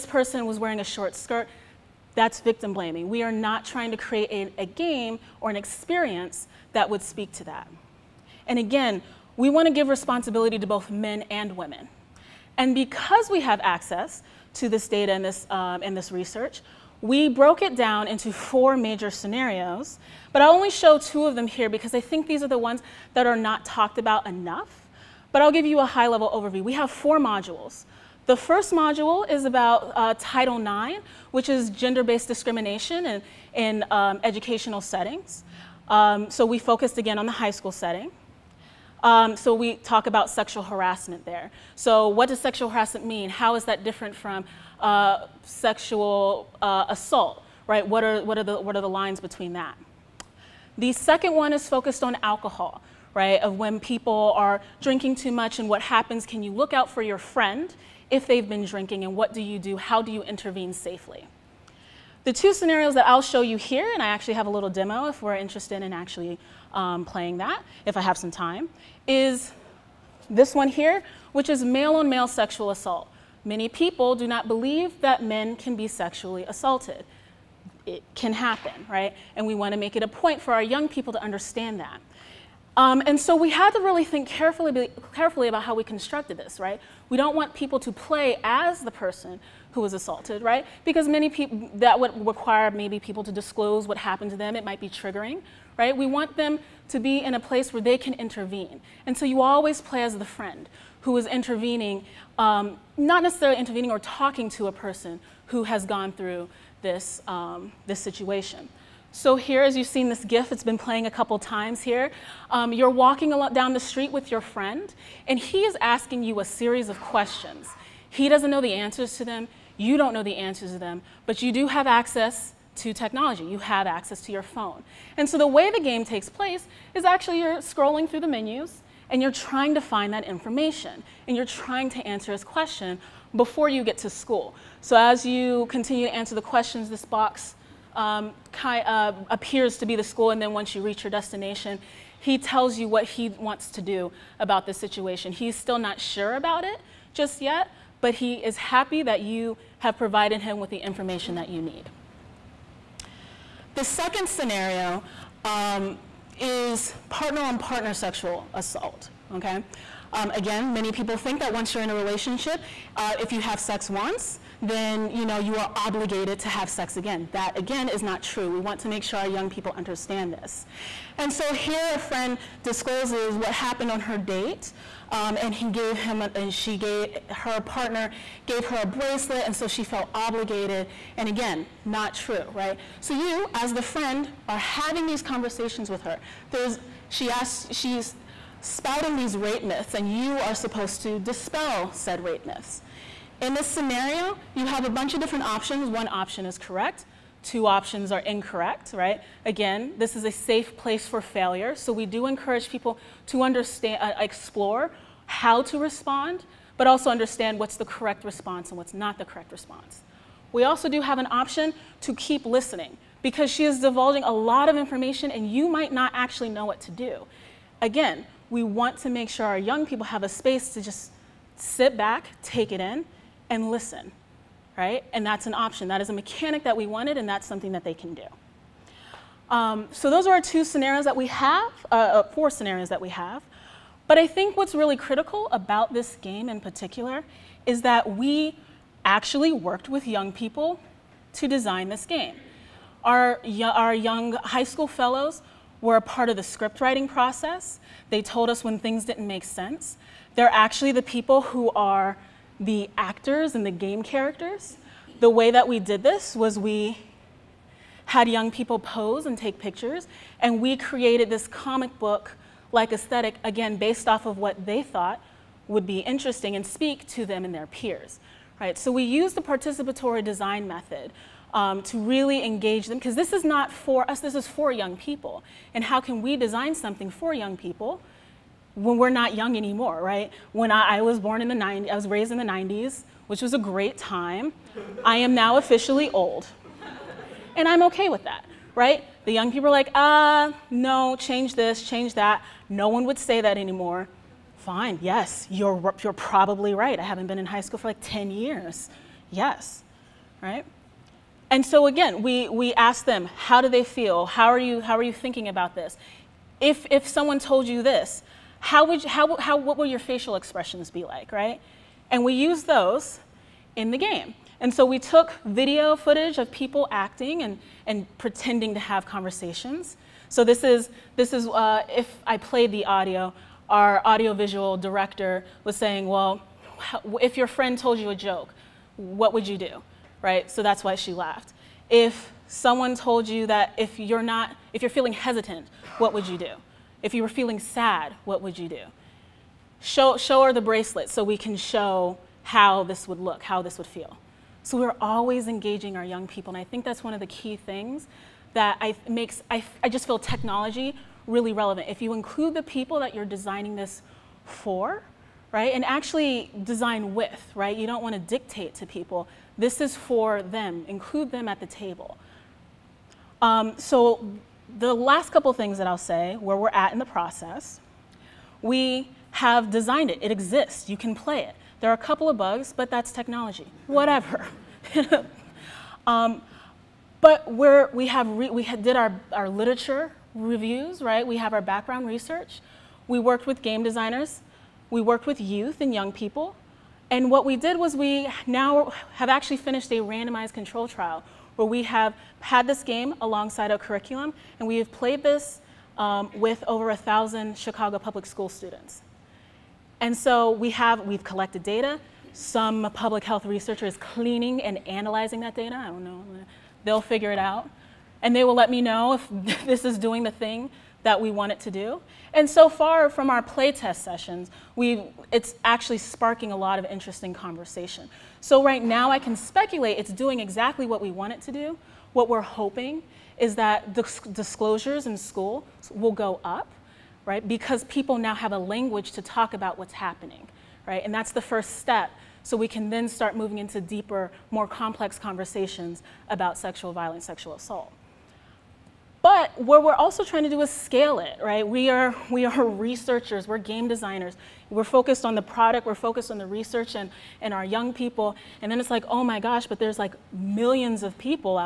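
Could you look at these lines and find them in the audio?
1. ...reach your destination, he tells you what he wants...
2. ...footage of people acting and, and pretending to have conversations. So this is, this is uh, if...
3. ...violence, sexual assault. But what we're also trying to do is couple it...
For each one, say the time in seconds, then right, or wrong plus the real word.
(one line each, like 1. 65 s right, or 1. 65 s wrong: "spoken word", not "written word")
1. 140 s right
2. 315 s right
3. 436 s wrong: "scale", not "couple".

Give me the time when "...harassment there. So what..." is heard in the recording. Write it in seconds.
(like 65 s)
40 s.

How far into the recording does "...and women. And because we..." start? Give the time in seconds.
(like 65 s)
11 s.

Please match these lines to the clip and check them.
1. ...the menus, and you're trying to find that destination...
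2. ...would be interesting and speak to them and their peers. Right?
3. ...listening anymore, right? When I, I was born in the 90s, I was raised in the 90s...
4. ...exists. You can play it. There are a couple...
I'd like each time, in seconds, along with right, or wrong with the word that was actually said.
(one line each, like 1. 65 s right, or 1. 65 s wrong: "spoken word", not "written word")
1. 128 s wrong: "information", not "destination"
2. 265 s right
3. 279 s wrong: "young", not "listening"
4. 370 s right.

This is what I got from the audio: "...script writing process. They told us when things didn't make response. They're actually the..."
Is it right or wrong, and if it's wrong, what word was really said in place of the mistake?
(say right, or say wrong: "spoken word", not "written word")
wrong: "sense", not "response".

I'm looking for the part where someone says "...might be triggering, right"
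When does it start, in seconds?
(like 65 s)
94 s.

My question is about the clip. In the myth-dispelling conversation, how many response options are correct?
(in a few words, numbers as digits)
1.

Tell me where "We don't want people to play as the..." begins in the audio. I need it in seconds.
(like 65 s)
87 s.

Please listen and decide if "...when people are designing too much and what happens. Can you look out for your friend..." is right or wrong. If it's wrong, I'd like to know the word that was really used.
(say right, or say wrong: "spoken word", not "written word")
wrong: "drinking", not "designing".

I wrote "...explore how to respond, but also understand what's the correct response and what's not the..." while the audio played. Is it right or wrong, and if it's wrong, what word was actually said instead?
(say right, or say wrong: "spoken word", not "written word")
right.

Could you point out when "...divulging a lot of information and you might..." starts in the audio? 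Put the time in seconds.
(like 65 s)
213 s.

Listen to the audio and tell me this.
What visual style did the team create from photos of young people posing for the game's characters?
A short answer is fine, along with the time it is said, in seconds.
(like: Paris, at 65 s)
Comic book, at 261 s.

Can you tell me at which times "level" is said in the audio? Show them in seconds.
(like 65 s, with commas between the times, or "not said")
26 s.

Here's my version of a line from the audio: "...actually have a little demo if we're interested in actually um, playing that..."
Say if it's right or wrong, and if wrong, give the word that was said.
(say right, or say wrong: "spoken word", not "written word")
right.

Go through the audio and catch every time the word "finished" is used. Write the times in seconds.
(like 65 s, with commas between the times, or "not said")
389 s.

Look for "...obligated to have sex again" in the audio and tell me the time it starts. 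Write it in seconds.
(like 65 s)
165 s.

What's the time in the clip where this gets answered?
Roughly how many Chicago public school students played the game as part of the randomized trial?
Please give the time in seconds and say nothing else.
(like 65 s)
396 s.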